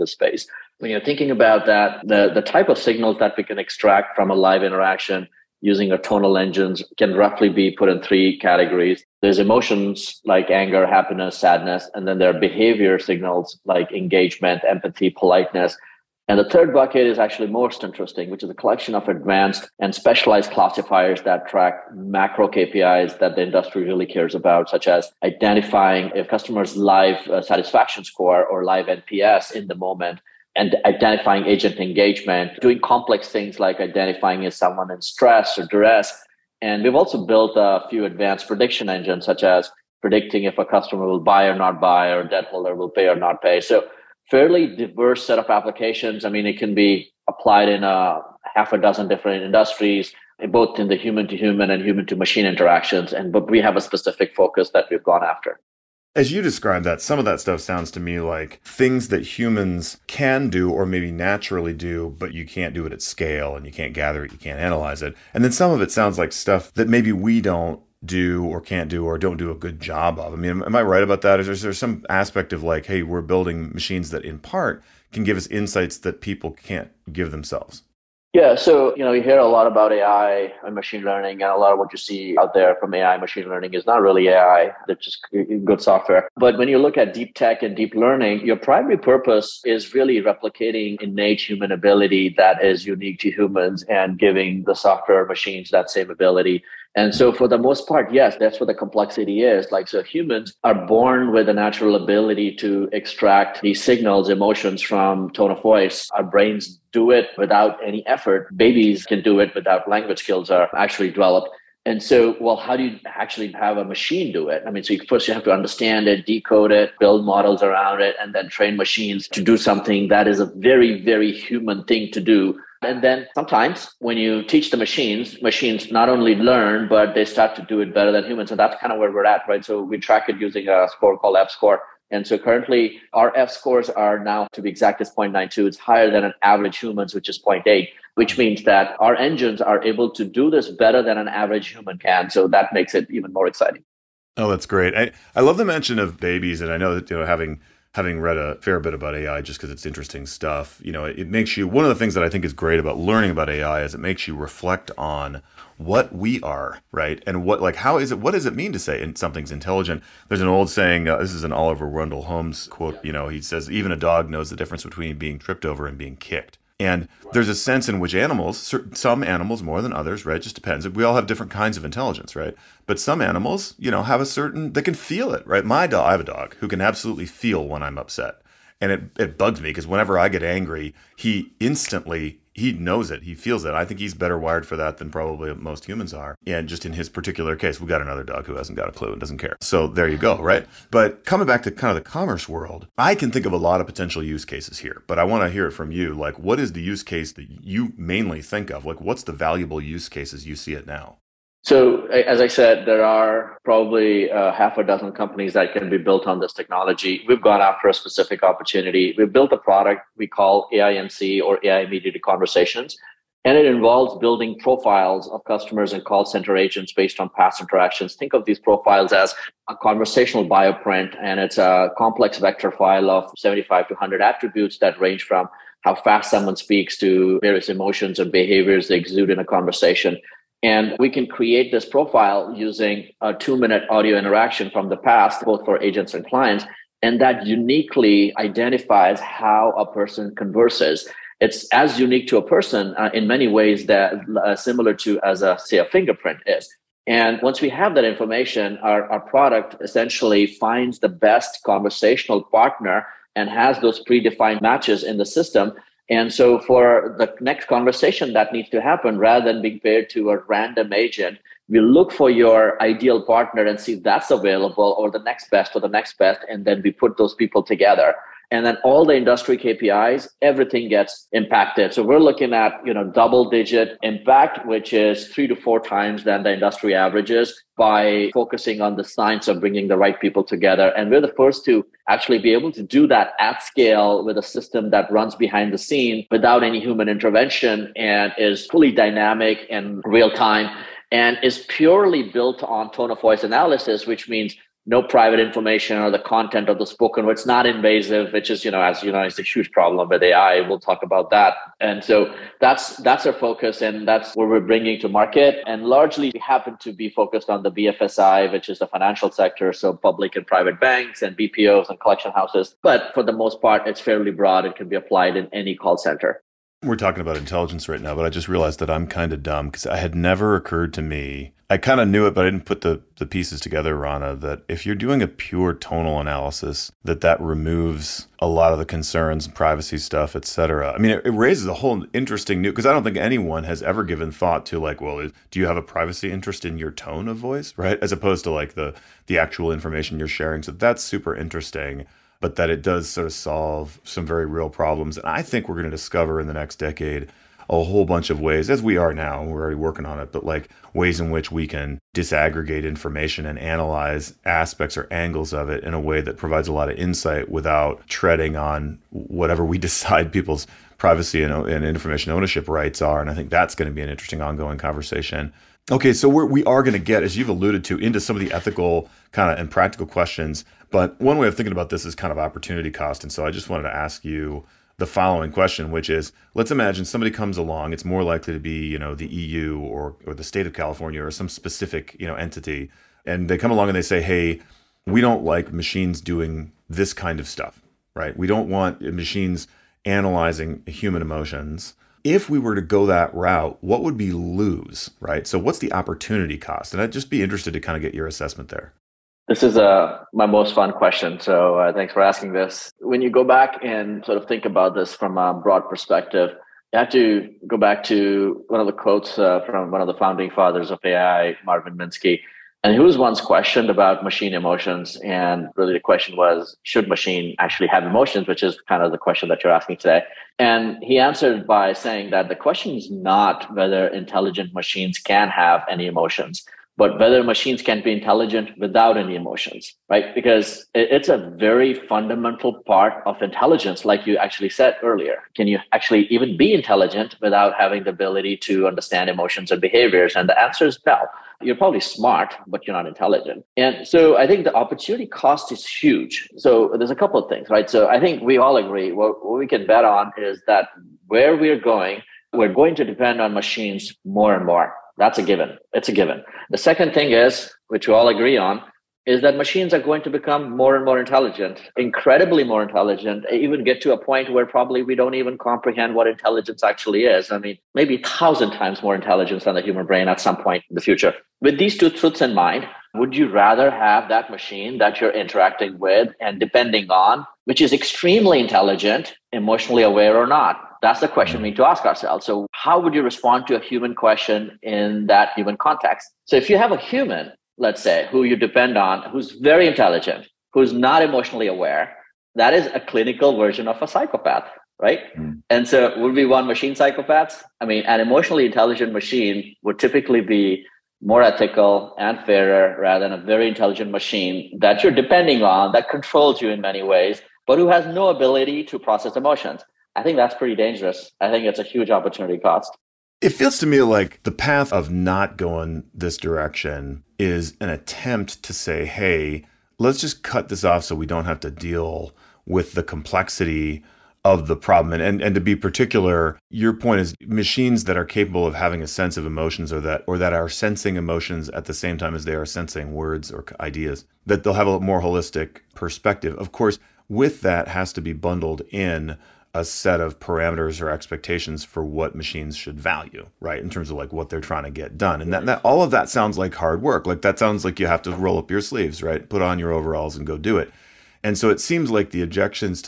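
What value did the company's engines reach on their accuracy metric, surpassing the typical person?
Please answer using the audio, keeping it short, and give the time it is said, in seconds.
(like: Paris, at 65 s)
0.92, at 135 s.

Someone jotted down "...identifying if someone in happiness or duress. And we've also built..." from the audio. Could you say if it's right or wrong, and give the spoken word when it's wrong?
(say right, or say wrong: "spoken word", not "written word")
wrong: "stress", not "happiness".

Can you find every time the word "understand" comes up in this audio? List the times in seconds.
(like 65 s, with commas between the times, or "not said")
115 s, 438 s.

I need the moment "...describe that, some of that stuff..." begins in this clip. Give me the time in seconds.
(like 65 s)
56 s.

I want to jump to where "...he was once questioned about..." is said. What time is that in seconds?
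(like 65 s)
412 s.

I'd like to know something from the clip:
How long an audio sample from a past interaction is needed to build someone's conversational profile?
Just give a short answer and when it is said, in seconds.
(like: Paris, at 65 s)
2 minutes, at 233 s.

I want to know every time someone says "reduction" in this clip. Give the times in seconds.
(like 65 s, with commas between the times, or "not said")
not said.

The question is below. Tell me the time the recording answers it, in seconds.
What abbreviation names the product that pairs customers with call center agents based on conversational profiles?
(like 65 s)
210 s.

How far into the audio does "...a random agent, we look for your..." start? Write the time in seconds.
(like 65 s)
260 s.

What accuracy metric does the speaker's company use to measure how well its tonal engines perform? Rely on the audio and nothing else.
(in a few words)
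F score.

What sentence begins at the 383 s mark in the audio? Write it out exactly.
And they come along and they say, hey, we don't like machines doing this kind of stuff, right?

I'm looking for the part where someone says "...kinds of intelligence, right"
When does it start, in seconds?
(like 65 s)
171 s.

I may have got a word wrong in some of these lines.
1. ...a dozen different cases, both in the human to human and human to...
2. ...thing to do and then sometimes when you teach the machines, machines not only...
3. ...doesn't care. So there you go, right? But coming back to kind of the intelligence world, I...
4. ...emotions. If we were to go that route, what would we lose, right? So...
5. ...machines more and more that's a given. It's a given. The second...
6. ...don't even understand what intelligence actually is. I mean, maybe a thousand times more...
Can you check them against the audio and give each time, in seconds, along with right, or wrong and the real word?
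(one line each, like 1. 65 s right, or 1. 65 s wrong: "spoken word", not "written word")
1. 48 s wrong: "industries", not "cases"
2. 121 s right
3. 189 s wrong: "commerce", not "intelligence"
4. 391 s right
5. 453 s right
6. 465 s wrong: "comprehend", not "understand".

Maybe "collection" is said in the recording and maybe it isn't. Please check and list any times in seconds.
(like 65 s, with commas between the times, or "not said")
18 s, 312 s.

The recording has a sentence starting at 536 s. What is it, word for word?
Of course, with that has to be bundled in a set of parameters or expectations for what machines should value, right?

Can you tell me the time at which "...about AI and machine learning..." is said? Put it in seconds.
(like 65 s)
79 s.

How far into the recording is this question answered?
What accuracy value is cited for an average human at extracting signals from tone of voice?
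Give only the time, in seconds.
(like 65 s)
137 s.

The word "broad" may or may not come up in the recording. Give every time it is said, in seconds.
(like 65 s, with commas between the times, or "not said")
314 s, 405 s.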